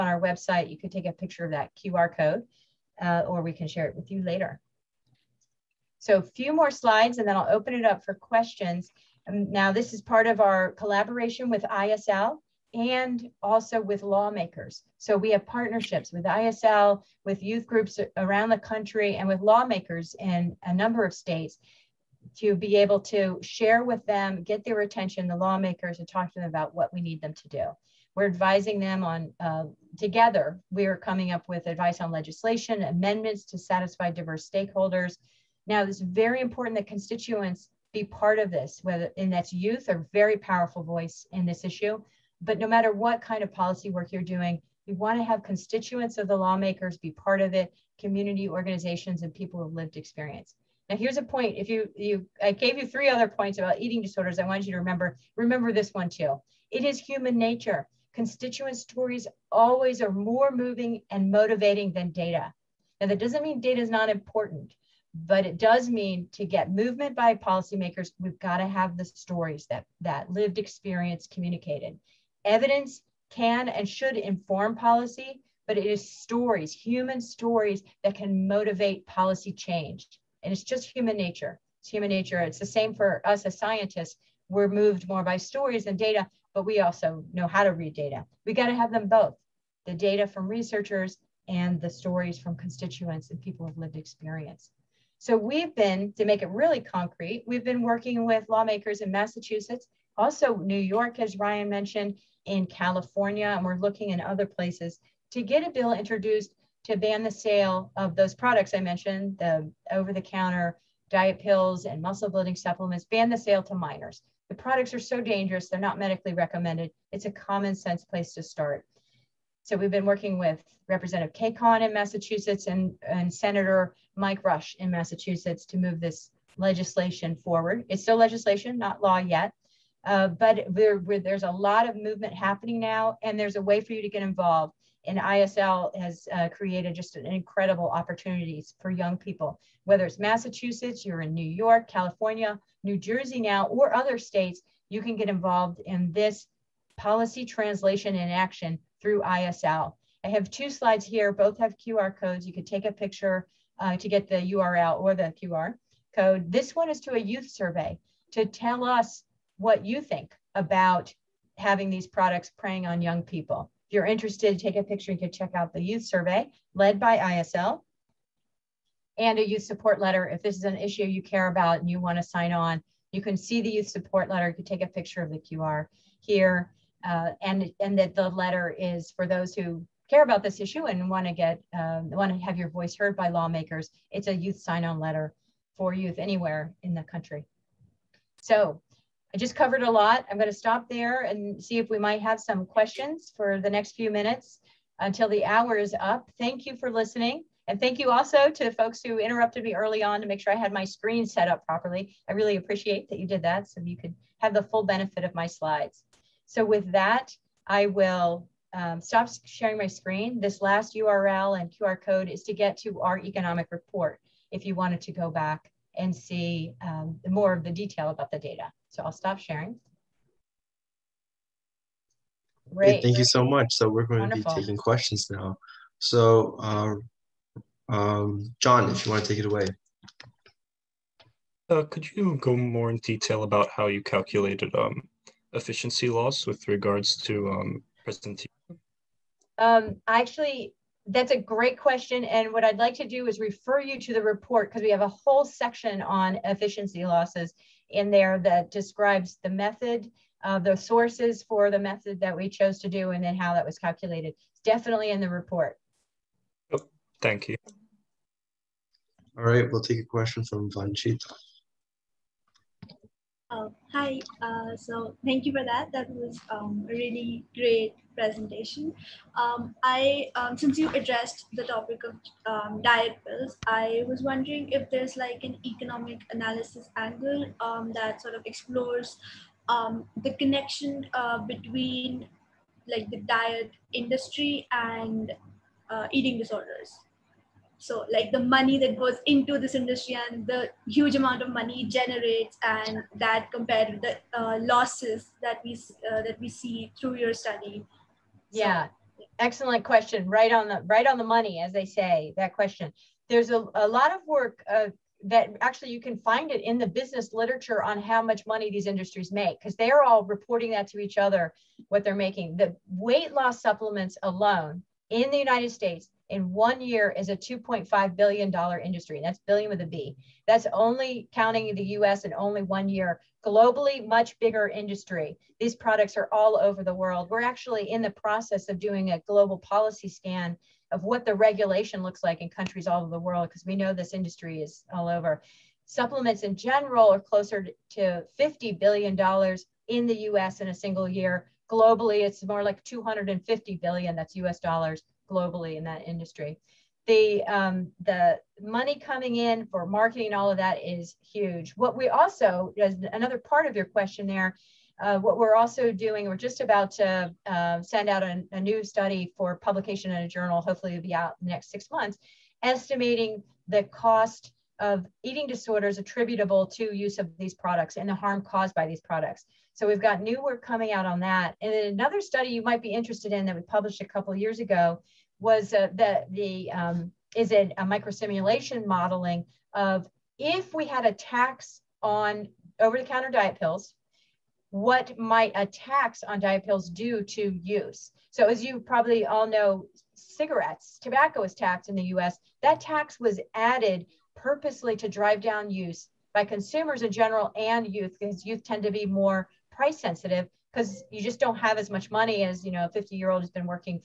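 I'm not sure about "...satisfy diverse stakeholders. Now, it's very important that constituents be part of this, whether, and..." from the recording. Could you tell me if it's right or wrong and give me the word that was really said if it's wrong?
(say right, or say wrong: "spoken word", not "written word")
right.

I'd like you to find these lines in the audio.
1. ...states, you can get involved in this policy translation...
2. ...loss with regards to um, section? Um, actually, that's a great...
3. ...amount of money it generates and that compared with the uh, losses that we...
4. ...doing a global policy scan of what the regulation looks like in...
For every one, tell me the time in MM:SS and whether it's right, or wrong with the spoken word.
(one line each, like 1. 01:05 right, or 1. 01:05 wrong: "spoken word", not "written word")
1. 02:24 right
2. 03:56 wrong: "presentation", not "section"
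3. 04:51 right
4. 05:28 right.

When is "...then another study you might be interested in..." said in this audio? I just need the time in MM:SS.
06:11.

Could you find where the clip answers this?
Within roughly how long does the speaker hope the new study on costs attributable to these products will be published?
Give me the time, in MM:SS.
06:01.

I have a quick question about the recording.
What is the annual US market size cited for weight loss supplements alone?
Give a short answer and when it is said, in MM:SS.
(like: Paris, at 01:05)
$2.5 billion, at 05:17.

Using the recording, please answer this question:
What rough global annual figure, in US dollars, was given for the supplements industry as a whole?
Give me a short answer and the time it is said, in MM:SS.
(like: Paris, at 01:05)
250 billion, at 05:42.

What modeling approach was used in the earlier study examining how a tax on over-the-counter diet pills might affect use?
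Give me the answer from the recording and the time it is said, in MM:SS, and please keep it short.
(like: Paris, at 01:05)
Microsimulation modeling, at 06:17.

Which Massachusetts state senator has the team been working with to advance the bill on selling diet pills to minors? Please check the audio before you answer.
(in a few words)
Mike Rush.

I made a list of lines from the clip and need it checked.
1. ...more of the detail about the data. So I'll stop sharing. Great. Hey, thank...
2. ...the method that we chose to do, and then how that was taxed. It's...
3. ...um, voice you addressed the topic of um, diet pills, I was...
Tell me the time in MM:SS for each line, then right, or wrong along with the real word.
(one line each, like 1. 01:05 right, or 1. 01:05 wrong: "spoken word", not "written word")
1. 03:37 right
2. 04:11 wrong: "calculated", not "taxed"
3. 04:30 wrong: "since", not "voice".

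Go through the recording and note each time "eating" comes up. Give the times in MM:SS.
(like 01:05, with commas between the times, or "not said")
00:53, 04:46, 06:05.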